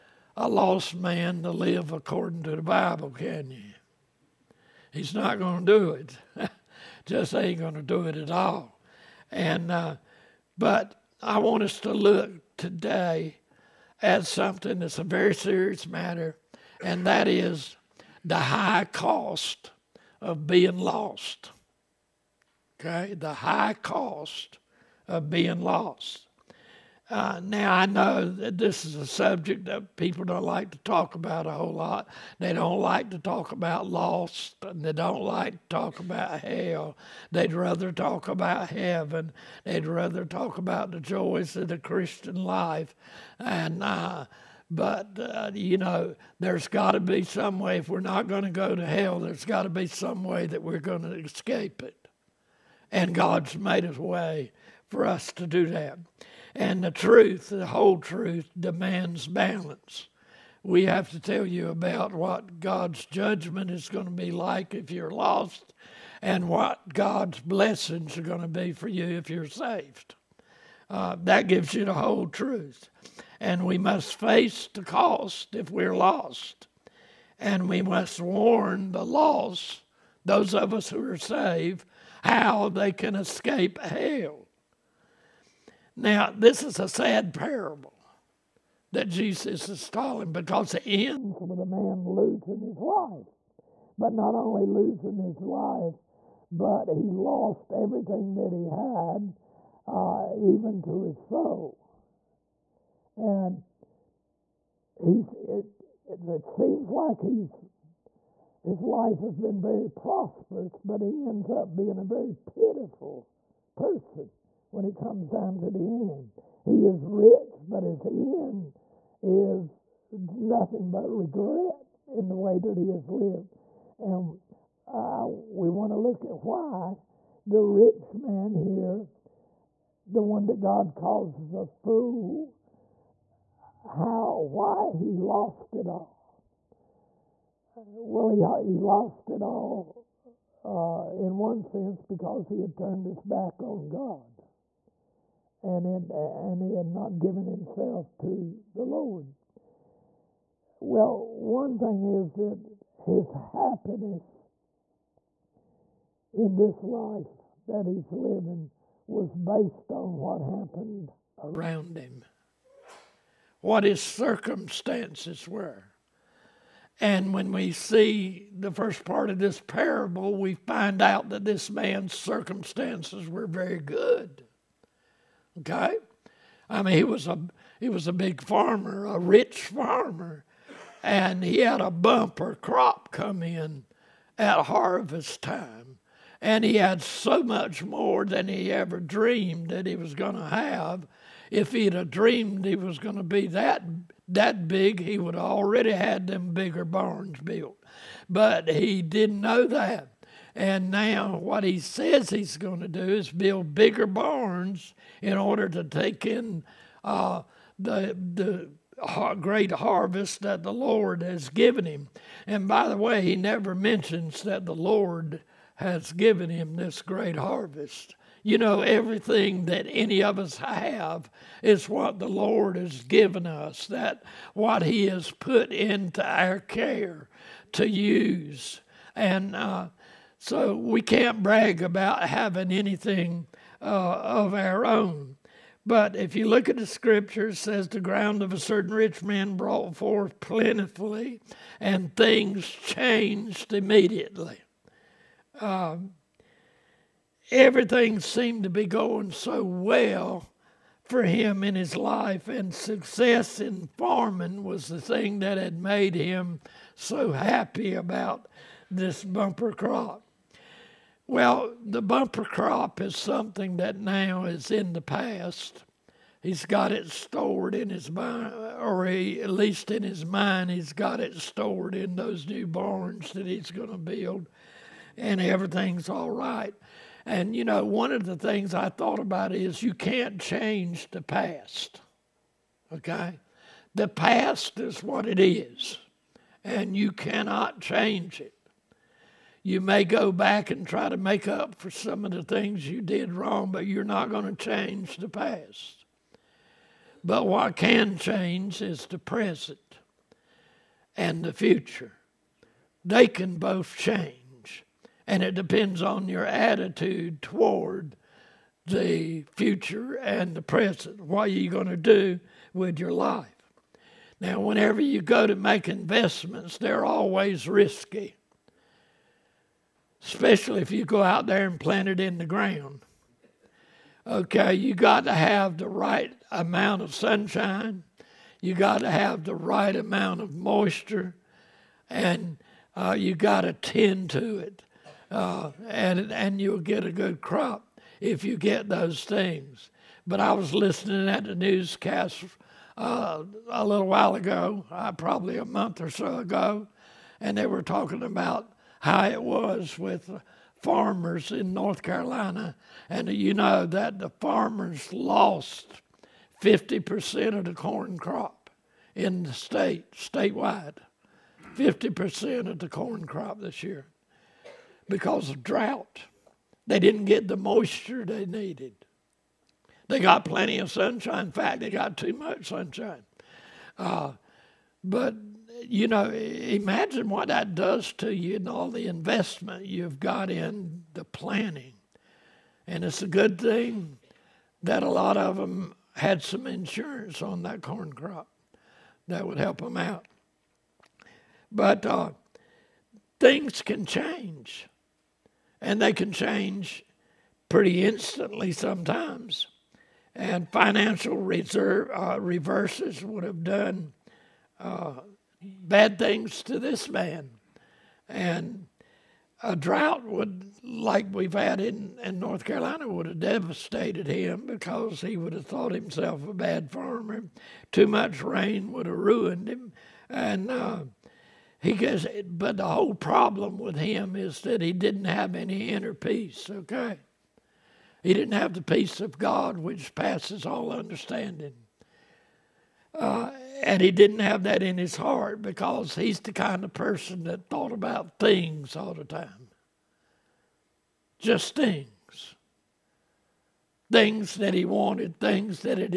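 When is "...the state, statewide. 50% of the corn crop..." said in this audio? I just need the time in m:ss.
5:59.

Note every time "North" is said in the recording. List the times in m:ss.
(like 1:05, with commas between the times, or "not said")
5:51, 6:52.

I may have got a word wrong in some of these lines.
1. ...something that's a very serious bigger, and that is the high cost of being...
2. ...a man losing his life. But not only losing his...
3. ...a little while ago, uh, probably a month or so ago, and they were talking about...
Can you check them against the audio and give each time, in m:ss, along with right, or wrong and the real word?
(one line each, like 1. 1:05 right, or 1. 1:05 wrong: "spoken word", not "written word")
1. 0:14 wrong: "matter", not "bigger"
2. 1:31 right
3. 5:43 right.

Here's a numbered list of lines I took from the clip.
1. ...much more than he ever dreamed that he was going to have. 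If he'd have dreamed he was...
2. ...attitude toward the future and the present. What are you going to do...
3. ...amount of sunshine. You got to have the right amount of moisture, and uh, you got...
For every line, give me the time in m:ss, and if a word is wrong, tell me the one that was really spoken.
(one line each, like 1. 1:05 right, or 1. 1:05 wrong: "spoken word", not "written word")
1. 3:07 right
2. 5:06 right
3. 5:26 right.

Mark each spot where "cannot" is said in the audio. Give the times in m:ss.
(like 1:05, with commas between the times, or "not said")
4:47.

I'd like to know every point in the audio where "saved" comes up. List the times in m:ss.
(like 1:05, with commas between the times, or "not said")
1:09, 1:21.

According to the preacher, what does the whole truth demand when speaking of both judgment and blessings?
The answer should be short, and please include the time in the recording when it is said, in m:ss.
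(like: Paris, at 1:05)
Balance, at 0:59.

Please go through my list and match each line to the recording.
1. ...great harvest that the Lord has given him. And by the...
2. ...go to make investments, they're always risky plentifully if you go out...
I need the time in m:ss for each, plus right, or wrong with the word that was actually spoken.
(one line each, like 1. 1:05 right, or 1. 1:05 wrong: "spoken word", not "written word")
1. 3:29 right
2. 5:15 wrong: "especially", not "plentifully".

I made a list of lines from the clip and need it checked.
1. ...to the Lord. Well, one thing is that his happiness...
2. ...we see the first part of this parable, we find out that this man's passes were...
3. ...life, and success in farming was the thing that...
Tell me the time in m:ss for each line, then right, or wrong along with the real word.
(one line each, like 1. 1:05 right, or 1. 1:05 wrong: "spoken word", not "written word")
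1. 2:28 right
2. 2:47 wrong: "circumstances", not "passes"
3. 4:11 right.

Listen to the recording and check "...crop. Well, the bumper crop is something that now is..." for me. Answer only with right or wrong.
right.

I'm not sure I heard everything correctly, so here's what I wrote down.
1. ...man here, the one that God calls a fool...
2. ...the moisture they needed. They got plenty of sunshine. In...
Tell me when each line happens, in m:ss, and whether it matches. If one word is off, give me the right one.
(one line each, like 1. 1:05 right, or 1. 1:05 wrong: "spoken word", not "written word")
1. 2:08 right
2. 6:07 right.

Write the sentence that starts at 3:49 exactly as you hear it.
And uh, so we can't brag about having anything uh, of our own.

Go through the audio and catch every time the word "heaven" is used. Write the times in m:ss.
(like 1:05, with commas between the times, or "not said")
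0:38.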